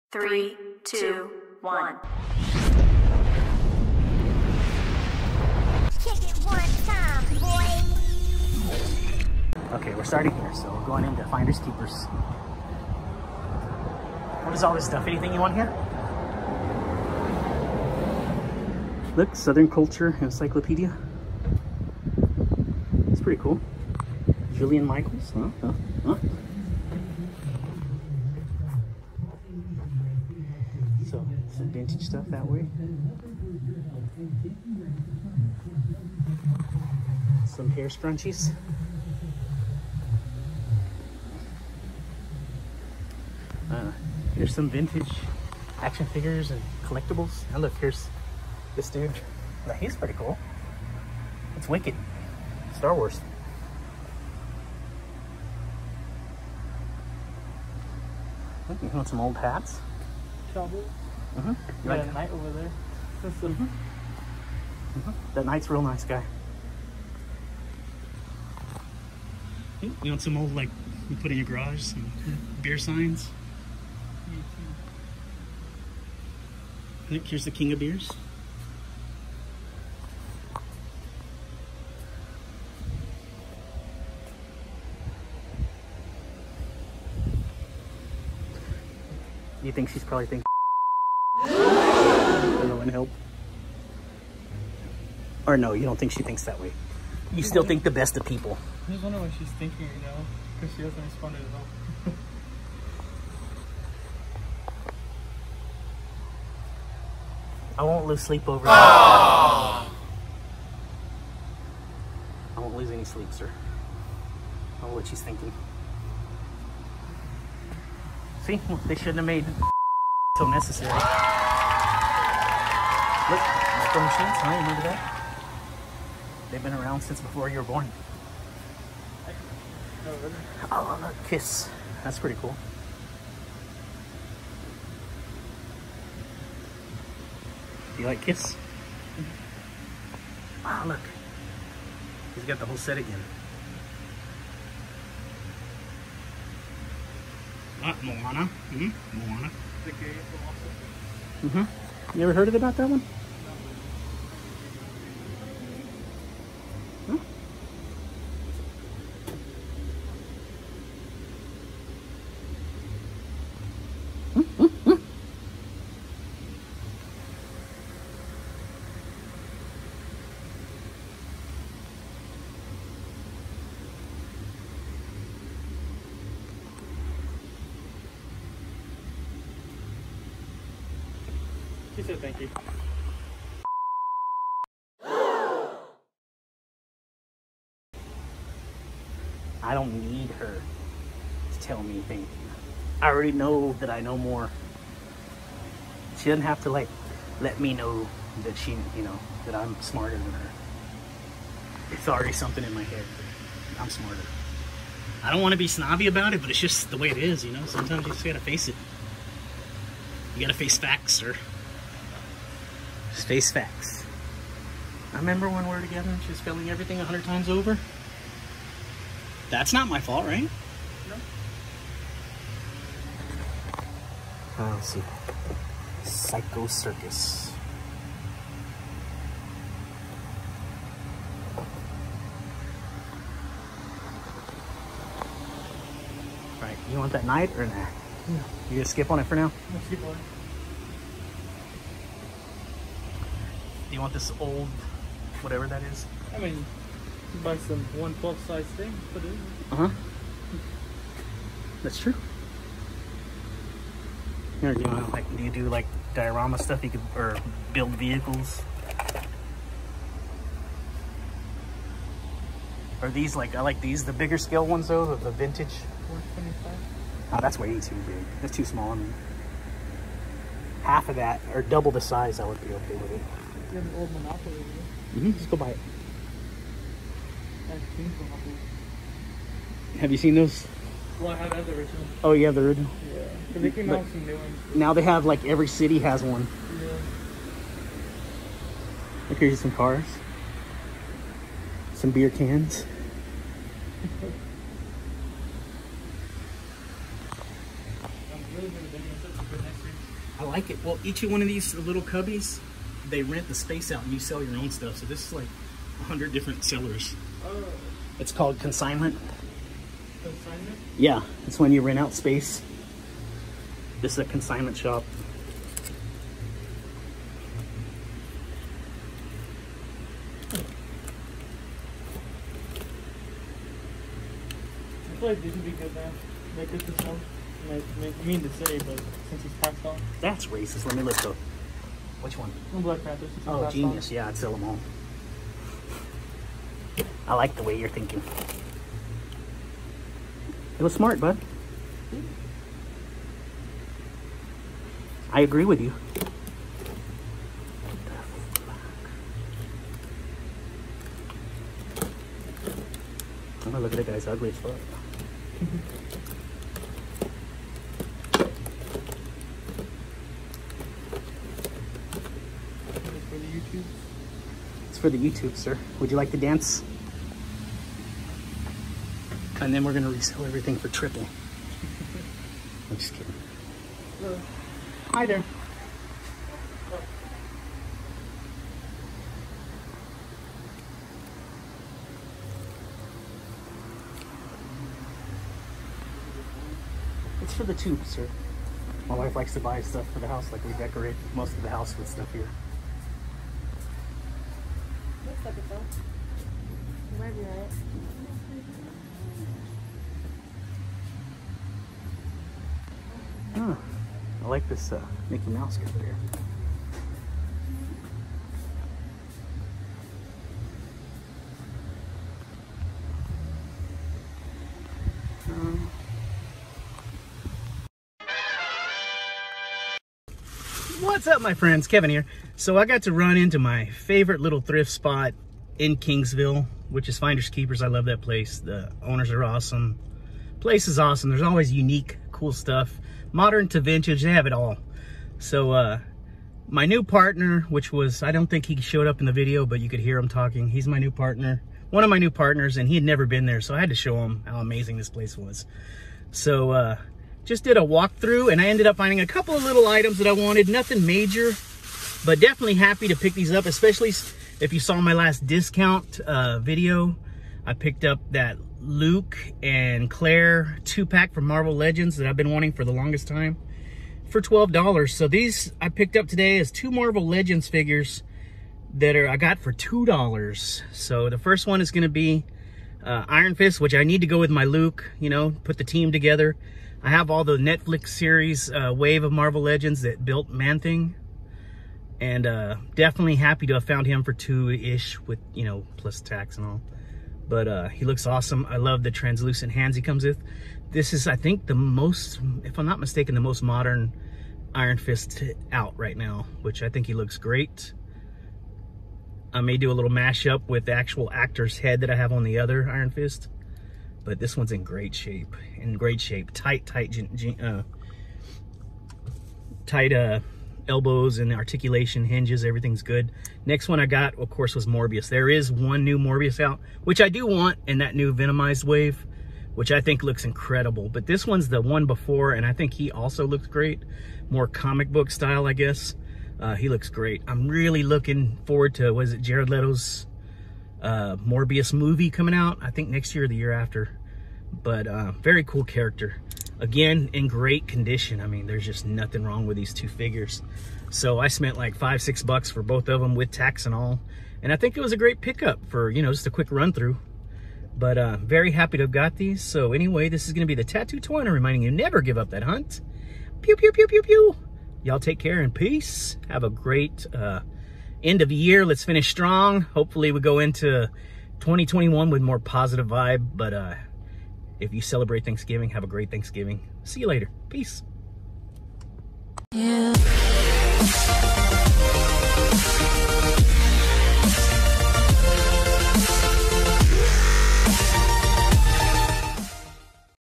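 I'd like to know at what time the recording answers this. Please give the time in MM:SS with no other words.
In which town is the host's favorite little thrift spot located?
07:05.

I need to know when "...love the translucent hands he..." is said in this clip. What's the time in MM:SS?
08:08.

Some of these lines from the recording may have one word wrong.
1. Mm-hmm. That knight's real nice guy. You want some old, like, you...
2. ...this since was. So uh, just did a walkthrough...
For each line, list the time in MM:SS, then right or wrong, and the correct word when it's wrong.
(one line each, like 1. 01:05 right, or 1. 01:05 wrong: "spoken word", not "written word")
1. 01:03 right
2. 07:24 wrong: "place", not "since".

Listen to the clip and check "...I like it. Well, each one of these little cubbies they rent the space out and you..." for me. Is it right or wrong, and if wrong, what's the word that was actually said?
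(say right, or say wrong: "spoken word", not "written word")
right.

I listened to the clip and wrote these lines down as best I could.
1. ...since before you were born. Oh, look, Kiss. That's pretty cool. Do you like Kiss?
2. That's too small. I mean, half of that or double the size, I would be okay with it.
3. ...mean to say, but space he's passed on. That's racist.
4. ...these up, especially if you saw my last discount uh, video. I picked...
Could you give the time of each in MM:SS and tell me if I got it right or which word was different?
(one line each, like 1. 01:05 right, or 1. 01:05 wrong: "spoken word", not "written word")
1. 02:06 right
2. 04:28 right
3. 05:28 wrong: "since", not "space"
4. 07:33 right.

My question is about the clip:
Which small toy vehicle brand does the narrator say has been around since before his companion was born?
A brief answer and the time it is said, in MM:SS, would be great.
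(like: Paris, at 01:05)
Micro Machines, at 02:03.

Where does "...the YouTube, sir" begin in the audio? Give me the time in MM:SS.
06:05.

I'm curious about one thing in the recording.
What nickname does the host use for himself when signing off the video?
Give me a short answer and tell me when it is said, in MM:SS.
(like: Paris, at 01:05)
Tattoo Twin, at 09:10.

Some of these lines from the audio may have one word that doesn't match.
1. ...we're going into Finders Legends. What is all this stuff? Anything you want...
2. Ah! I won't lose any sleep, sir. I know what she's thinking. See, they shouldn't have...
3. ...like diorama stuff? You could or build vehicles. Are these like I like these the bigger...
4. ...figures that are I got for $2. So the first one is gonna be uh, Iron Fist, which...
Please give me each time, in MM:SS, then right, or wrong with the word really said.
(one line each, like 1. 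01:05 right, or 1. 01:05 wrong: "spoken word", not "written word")
1. 00:10 wrong: "Keepers", not "Legends"
2. 01:48 right
3. 04:15 right
4. 07:47 right.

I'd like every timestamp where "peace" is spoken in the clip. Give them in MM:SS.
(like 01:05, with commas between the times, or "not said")
09:15, 09:27.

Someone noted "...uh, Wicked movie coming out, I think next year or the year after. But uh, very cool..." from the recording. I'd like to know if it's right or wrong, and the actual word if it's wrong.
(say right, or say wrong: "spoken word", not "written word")
wrong: "Morbius", not "Wicked".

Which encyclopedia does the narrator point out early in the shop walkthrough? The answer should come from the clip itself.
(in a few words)
Southern Culture Encyclopedia.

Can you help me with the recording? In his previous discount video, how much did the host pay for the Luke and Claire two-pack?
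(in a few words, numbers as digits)
$12.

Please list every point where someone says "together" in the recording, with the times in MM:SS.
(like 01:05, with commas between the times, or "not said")
03:35, 07:56.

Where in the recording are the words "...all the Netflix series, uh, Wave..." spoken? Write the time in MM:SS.
07:57.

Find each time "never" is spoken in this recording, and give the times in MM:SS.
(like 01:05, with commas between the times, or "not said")
07:23, 09:11.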